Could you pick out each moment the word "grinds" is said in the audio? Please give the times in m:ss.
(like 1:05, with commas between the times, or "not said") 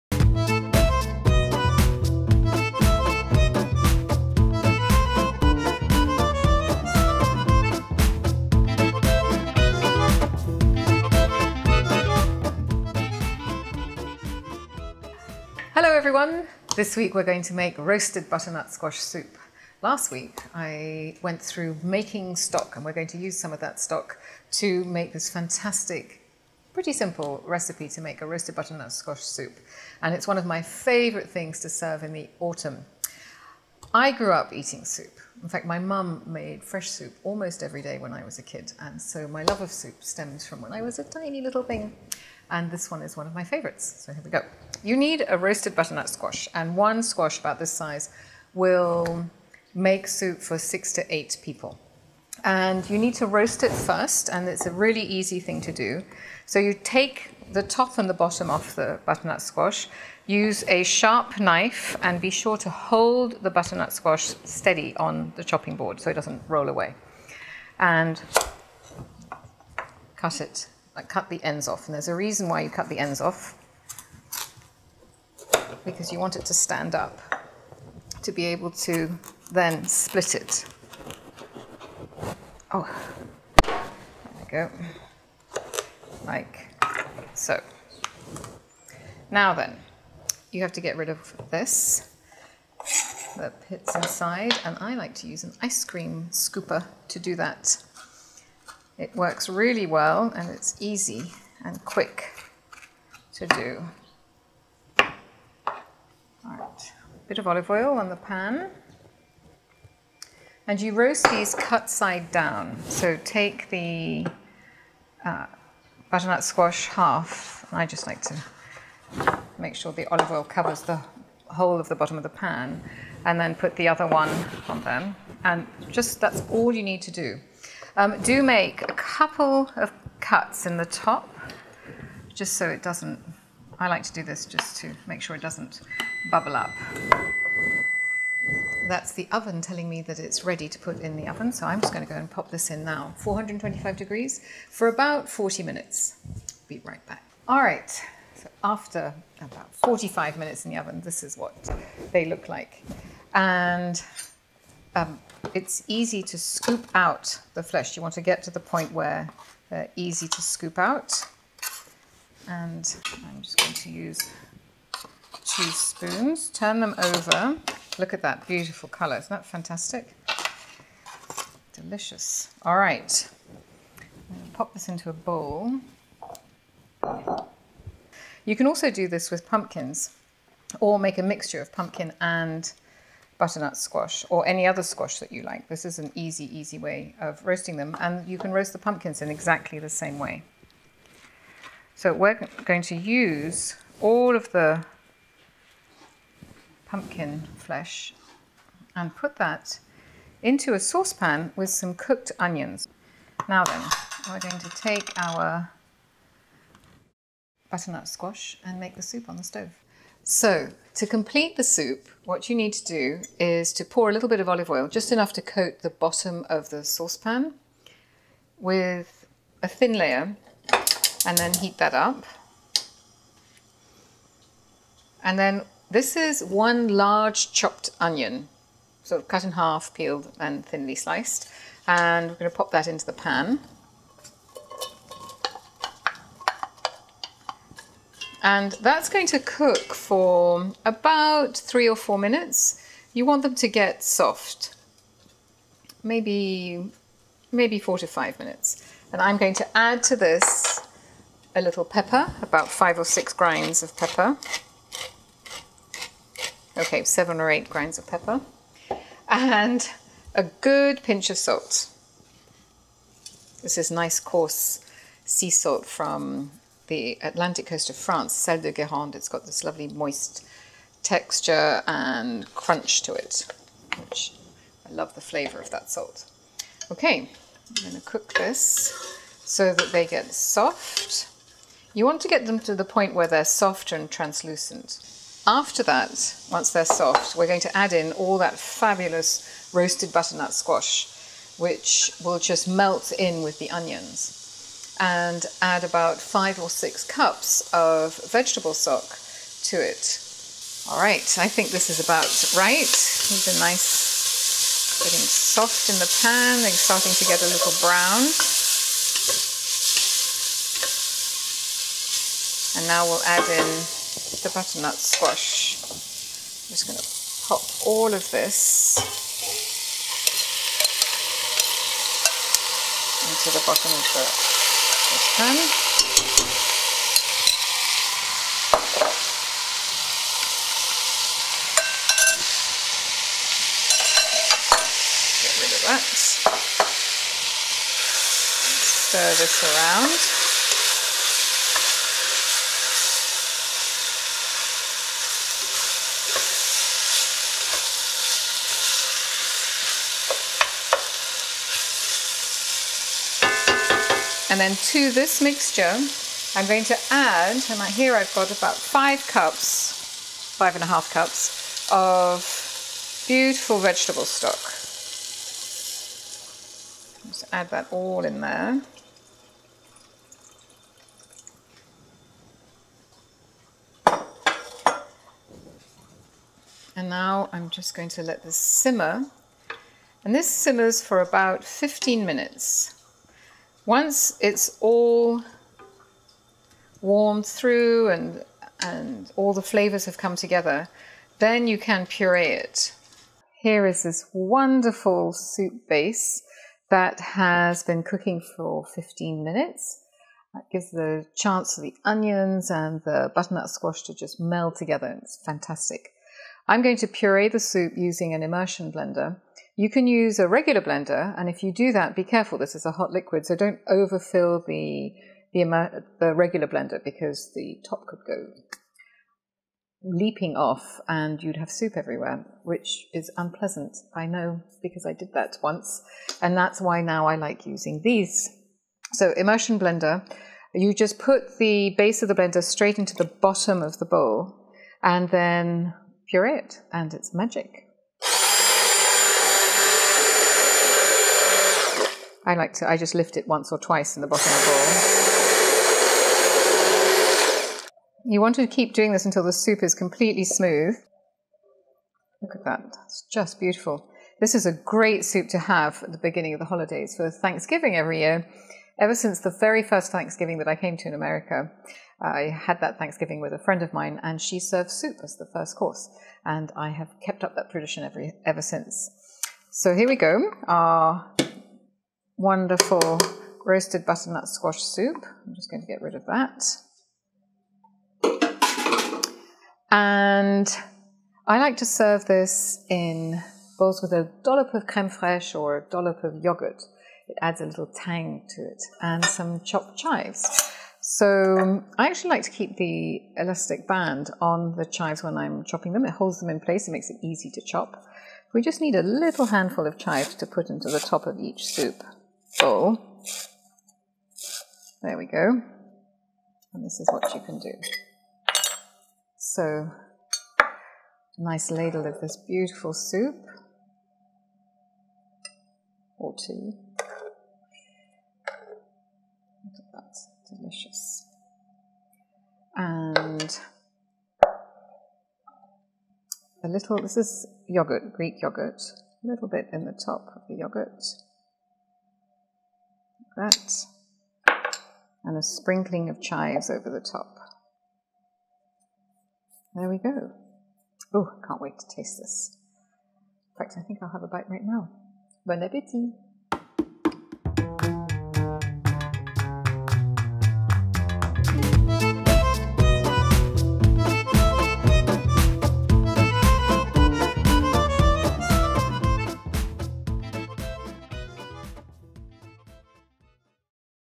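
4:13, 4:17.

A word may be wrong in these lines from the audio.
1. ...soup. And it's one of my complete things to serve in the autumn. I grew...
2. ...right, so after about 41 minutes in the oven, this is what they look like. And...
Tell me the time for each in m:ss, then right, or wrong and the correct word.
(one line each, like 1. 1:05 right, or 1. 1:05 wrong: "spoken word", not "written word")
1. 0:29 wrong: "favorite", not "complete"
2. 2:27 wrong: "45", not "41".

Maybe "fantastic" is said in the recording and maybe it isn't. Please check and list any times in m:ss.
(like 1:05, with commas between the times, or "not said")
0:25, 2:49, 6:45.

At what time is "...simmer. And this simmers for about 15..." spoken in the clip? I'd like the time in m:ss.
6:18.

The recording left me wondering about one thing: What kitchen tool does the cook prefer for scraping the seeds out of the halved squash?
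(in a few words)
ice cream scooper.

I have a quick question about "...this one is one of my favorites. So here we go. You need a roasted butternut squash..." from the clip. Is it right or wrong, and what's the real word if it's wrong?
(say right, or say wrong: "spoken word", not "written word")
right.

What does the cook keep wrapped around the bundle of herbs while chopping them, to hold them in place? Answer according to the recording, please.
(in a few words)
elastic band.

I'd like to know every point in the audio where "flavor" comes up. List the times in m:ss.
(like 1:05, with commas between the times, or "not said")
4:35, 6:29.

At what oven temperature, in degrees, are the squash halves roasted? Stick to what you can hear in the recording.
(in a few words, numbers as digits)
425.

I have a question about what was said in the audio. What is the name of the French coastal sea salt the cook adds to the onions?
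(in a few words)
sel de Guérande.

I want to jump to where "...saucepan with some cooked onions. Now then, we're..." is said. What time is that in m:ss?
3:20.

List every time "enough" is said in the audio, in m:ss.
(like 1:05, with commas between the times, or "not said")
3:35.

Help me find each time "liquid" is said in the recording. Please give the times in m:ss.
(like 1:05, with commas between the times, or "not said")
6:53.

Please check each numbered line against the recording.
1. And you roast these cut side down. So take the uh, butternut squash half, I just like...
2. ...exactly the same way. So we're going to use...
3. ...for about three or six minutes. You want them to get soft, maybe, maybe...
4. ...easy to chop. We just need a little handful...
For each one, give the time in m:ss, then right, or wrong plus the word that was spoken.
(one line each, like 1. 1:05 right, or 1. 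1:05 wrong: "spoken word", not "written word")
1. 1:50 right
2. 3:09 right
3. 3:59 wrong: "four", not "six"
4. 8:17 right.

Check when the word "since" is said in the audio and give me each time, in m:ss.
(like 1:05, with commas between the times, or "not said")
7:39, 7:48.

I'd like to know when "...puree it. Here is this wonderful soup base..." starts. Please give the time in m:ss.
6:32.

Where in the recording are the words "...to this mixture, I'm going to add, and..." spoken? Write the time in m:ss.
5:54.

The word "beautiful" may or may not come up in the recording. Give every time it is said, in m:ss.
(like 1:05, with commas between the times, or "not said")
2:48, 6:03, 7:33, 8:32.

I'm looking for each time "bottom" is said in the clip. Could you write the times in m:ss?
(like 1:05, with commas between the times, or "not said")
0:58, 2:01, 3:35, 5:23, 7:13, 7:24.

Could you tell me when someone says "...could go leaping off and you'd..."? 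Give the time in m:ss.
6:58.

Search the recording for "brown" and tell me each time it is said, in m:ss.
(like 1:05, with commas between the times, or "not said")
5:07.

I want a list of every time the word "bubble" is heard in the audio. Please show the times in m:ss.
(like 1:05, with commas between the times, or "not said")
2:16.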